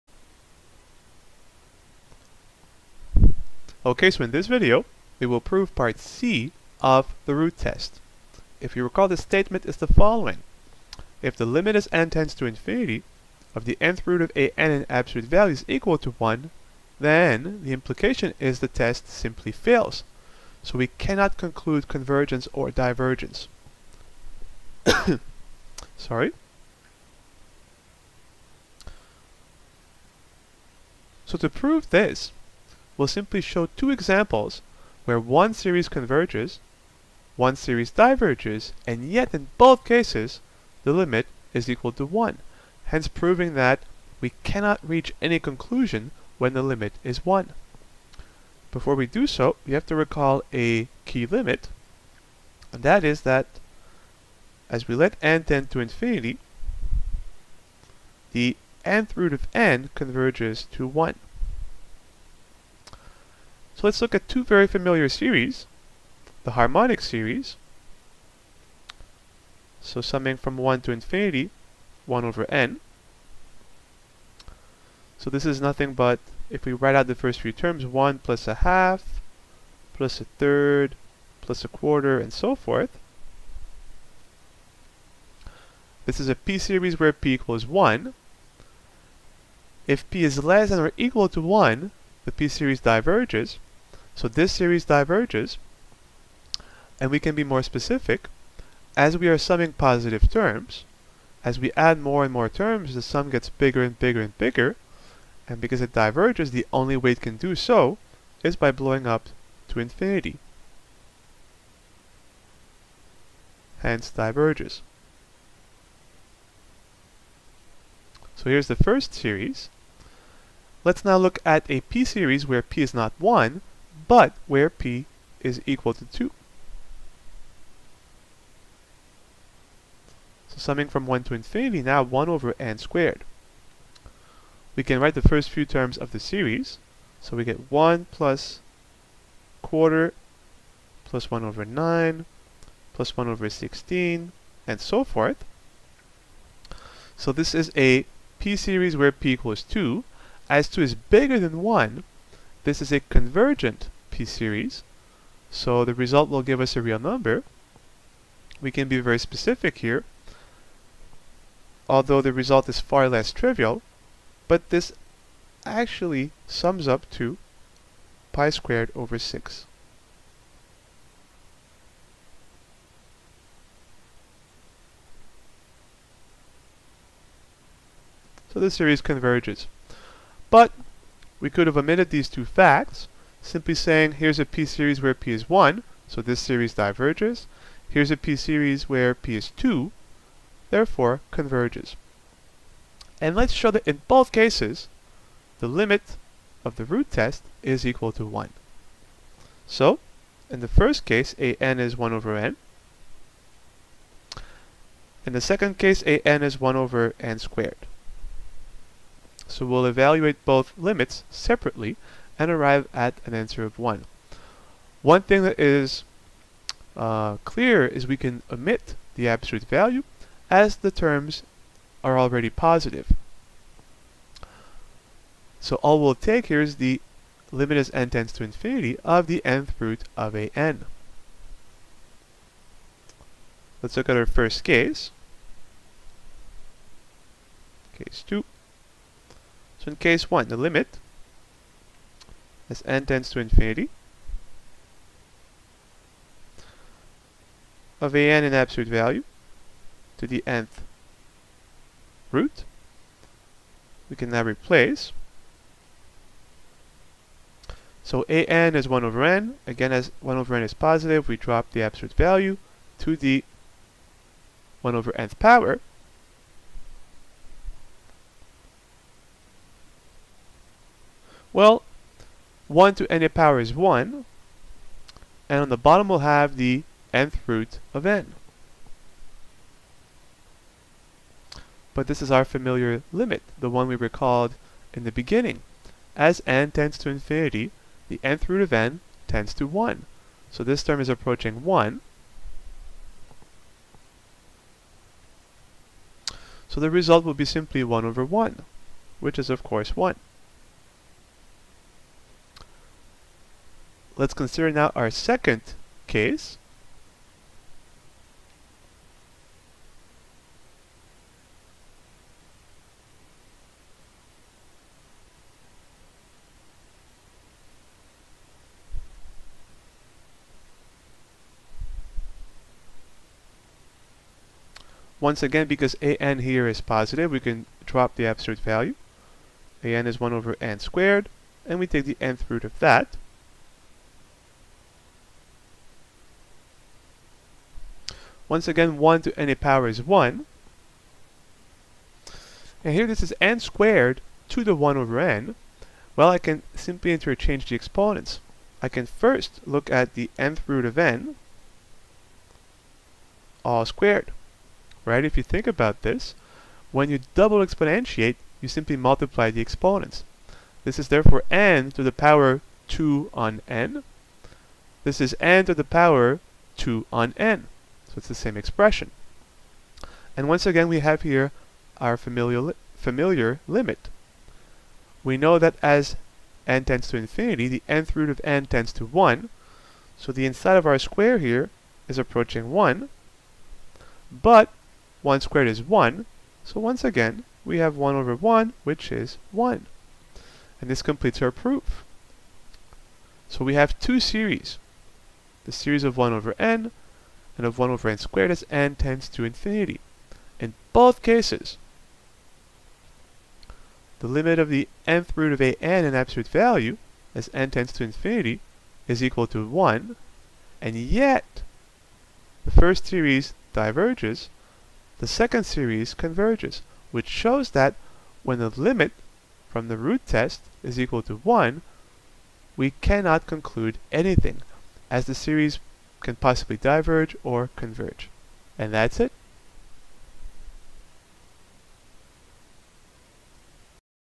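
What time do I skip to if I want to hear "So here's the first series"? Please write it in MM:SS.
01:58.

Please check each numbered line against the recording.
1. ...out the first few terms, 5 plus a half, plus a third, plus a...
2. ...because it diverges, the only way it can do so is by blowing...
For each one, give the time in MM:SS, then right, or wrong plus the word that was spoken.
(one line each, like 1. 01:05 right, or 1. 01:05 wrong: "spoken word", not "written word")
1. 01:16 wrong: "1", not "5"
2. 01:45 right.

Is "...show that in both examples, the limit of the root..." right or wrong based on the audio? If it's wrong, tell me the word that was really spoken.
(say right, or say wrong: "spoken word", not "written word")
wrong: "cases", not "examples".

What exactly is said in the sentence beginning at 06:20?
So the inside of our square here is approaching 1.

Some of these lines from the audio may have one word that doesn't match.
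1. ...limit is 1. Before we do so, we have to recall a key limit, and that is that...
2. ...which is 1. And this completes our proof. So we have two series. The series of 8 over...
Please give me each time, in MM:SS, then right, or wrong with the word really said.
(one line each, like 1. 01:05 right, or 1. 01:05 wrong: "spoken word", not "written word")
1. 00:46 right
2. 06:28 wrong: "1", not "8".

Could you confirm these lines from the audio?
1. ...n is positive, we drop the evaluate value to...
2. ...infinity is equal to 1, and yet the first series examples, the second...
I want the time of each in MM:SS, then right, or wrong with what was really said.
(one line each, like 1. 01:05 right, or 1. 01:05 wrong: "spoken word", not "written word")
1. 04:20 wrong: "absolute", not "evaluate"
2. 06:48 wrong: "diverges", not "examples".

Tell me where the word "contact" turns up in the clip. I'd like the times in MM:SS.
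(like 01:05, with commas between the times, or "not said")
not said.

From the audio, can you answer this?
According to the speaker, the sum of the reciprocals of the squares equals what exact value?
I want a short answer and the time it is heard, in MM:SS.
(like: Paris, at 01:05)
pi squared over 6, at 02:48.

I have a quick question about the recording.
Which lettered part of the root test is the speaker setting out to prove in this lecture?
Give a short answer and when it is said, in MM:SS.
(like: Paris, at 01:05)
Part C, at 00:05.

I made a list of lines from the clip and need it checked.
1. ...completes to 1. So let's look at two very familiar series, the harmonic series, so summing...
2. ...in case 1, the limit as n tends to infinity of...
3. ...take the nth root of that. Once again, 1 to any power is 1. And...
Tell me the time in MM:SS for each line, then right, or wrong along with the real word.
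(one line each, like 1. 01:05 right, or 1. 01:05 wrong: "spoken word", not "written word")
1. 00:59 wrong: "converges", not "completes"
2. 03:59 right
3. 05:31 right.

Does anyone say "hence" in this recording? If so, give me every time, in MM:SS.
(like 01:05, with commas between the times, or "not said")
00:42, 01:53.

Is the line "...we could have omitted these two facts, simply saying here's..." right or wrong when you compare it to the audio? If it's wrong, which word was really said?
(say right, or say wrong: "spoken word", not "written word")
right.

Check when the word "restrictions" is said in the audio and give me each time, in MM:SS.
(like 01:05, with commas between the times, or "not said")
not said.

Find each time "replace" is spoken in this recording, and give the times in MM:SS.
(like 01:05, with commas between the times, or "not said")
04:14.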